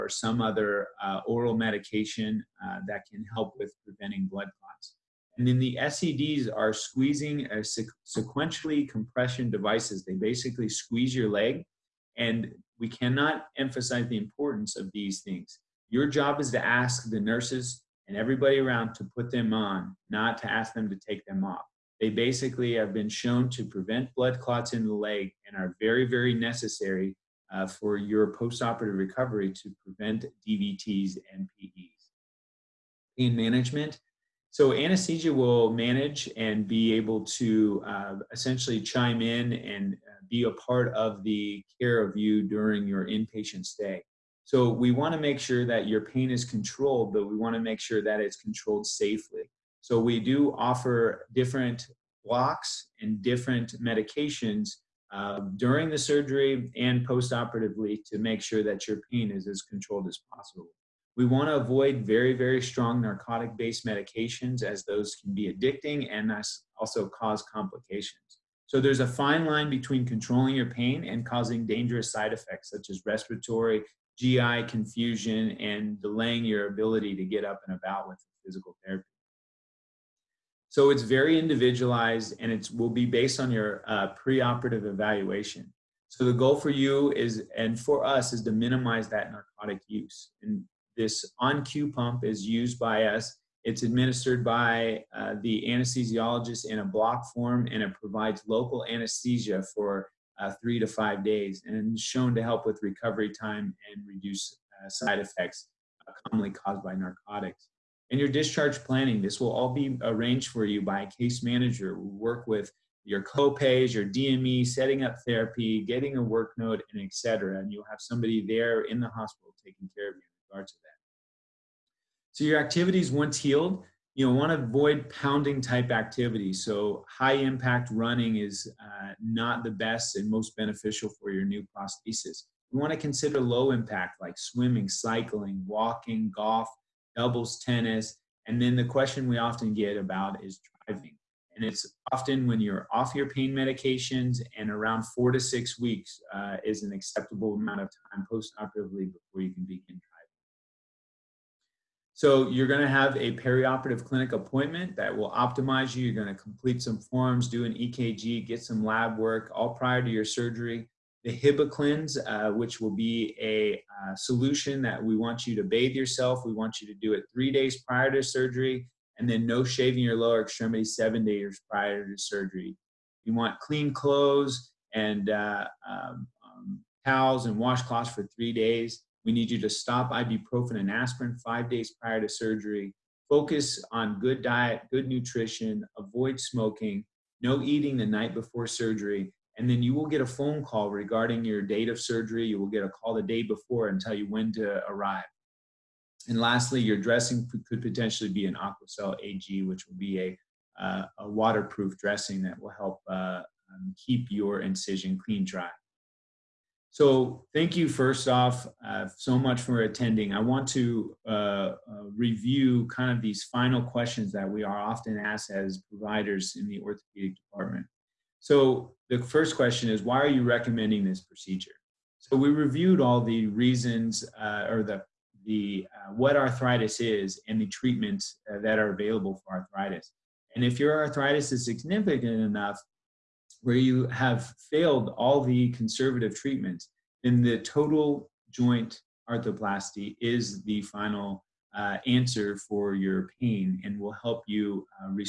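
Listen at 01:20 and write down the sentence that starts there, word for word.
So it's very individualized and it will be based on your uh, preoperative evaluation.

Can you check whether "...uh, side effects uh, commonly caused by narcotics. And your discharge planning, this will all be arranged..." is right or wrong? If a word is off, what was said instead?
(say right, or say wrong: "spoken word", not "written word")
right.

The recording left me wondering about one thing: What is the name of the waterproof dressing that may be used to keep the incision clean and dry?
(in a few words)
Aquacel AG.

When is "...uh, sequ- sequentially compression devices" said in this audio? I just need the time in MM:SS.
00:07.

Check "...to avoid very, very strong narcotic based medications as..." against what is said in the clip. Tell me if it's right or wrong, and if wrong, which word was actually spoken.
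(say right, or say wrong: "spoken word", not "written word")
right.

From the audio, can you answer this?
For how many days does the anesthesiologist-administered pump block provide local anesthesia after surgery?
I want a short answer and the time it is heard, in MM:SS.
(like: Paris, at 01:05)
3 to 5 days, at 01:40.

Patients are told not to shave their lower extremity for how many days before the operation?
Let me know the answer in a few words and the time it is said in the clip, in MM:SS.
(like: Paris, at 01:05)
7 days, at 02:50.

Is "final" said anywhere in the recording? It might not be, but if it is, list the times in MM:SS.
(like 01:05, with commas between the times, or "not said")
03:33, 04:00.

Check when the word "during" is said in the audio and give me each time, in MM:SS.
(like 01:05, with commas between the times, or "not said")
00:42, 00:55.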